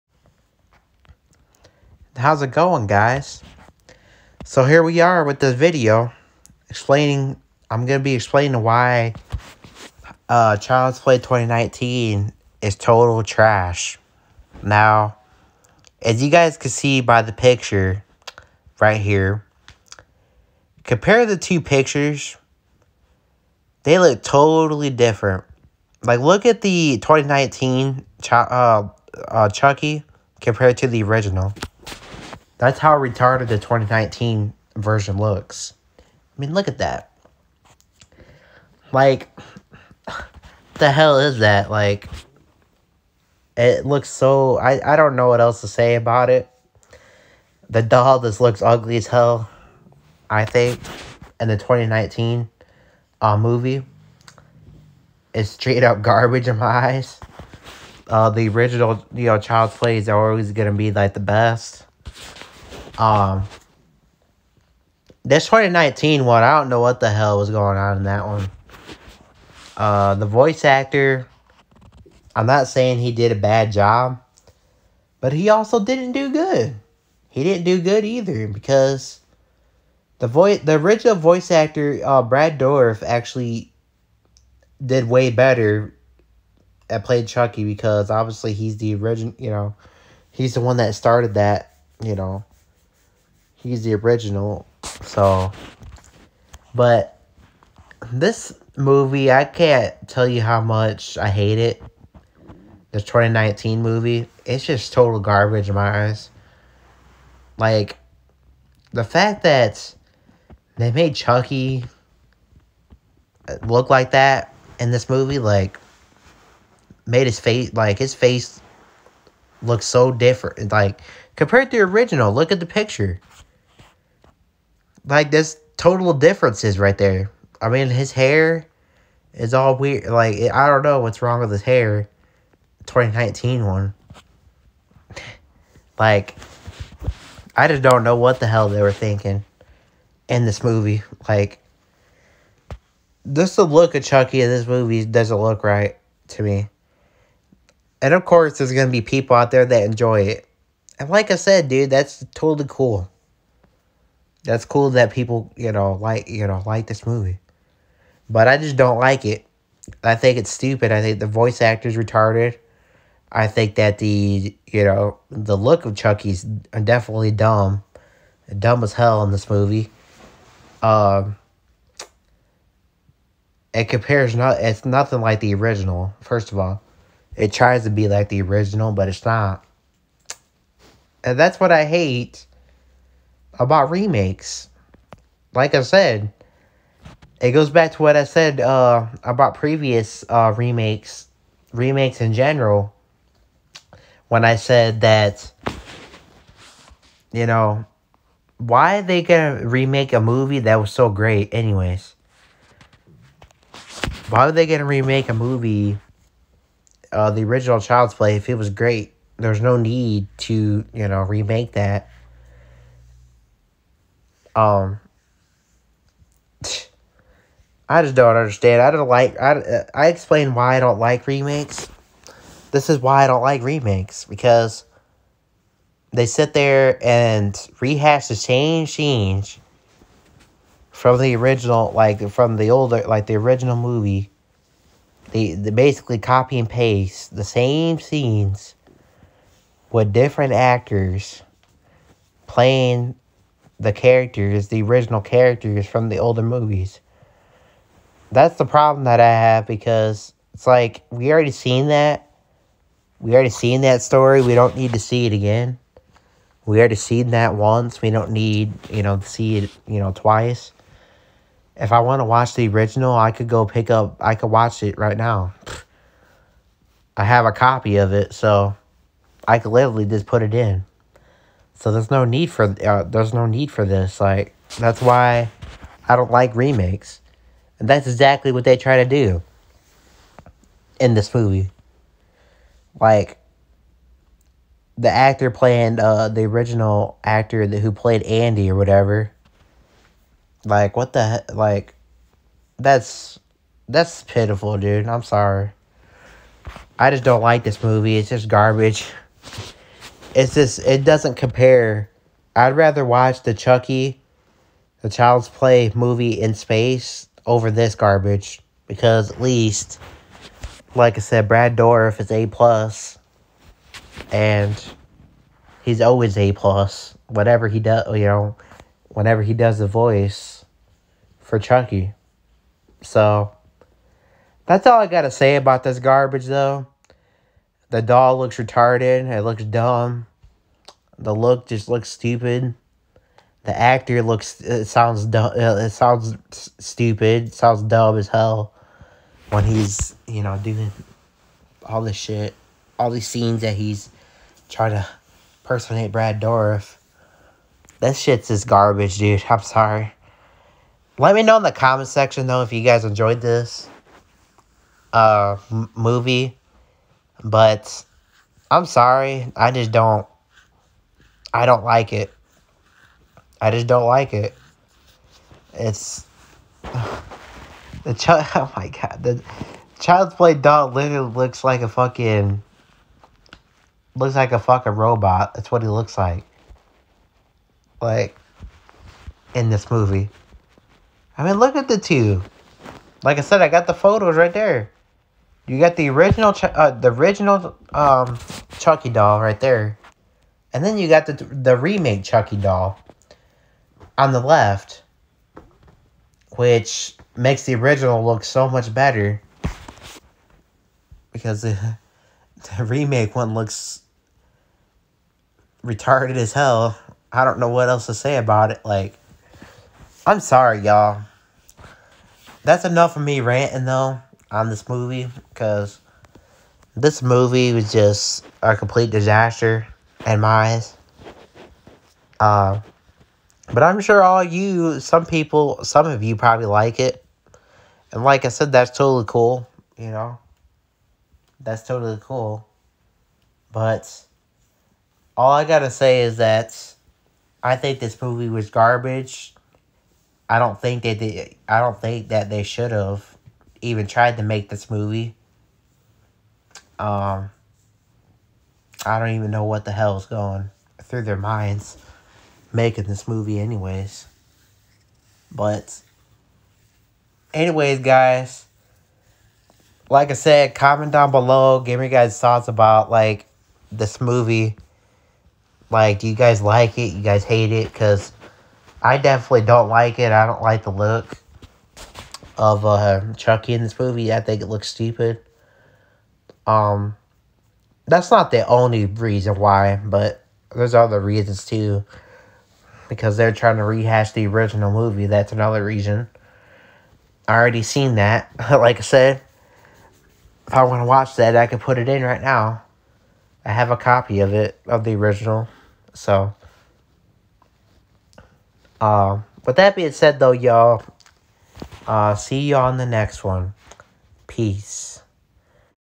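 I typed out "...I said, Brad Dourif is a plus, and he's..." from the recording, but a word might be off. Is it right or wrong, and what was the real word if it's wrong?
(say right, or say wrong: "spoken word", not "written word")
right.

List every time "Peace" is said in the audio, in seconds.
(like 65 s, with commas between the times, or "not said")
504 s.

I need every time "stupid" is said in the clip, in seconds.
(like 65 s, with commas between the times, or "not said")
160 s, 332 s, 336 s, 474 s.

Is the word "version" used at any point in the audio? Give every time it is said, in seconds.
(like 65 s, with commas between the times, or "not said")
34 s.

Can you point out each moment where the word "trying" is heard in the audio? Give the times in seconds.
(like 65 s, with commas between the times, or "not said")
344 s, 483 s.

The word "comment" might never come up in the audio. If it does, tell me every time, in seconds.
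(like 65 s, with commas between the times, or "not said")
351 s, 460 s.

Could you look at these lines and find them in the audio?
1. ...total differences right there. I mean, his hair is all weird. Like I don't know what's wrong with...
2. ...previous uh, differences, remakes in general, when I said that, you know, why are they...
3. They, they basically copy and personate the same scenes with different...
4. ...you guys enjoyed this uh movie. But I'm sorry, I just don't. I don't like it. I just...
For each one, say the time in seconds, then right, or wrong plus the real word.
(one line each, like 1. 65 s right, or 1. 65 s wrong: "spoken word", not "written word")
1. 125 s right
2. 189 s wrong: "remakes", not "differences"
3. 235 s wrong: "paste", not "personate"
4. 352 s right.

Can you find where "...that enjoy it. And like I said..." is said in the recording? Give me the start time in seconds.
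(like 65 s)
149 s.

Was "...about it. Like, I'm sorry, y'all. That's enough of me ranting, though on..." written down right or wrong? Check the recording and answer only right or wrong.
right.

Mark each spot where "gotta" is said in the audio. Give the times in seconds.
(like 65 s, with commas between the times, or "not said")
325 s, 435 s.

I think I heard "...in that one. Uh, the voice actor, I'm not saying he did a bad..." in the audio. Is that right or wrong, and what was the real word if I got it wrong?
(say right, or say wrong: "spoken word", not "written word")
right.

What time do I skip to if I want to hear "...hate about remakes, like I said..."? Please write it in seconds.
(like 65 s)
181 s.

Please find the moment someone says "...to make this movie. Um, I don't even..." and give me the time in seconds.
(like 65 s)
444 s.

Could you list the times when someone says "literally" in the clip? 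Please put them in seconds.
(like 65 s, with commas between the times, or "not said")
269 s, 370 s.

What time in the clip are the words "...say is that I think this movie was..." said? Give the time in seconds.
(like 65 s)
435 s.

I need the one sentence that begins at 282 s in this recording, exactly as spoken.
Like the actor playing uh the original actor that, who played Andy or whatever.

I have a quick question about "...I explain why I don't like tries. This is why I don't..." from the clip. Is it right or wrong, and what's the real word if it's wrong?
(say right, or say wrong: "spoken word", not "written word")
wrong: "remakes", not "tries".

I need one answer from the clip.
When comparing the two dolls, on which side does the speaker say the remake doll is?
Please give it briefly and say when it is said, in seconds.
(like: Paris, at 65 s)
the left, at 394 s.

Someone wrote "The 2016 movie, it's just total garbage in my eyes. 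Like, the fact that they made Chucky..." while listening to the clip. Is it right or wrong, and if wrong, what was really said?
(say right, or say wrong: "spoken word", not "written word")
wrong: "2019", not "2016".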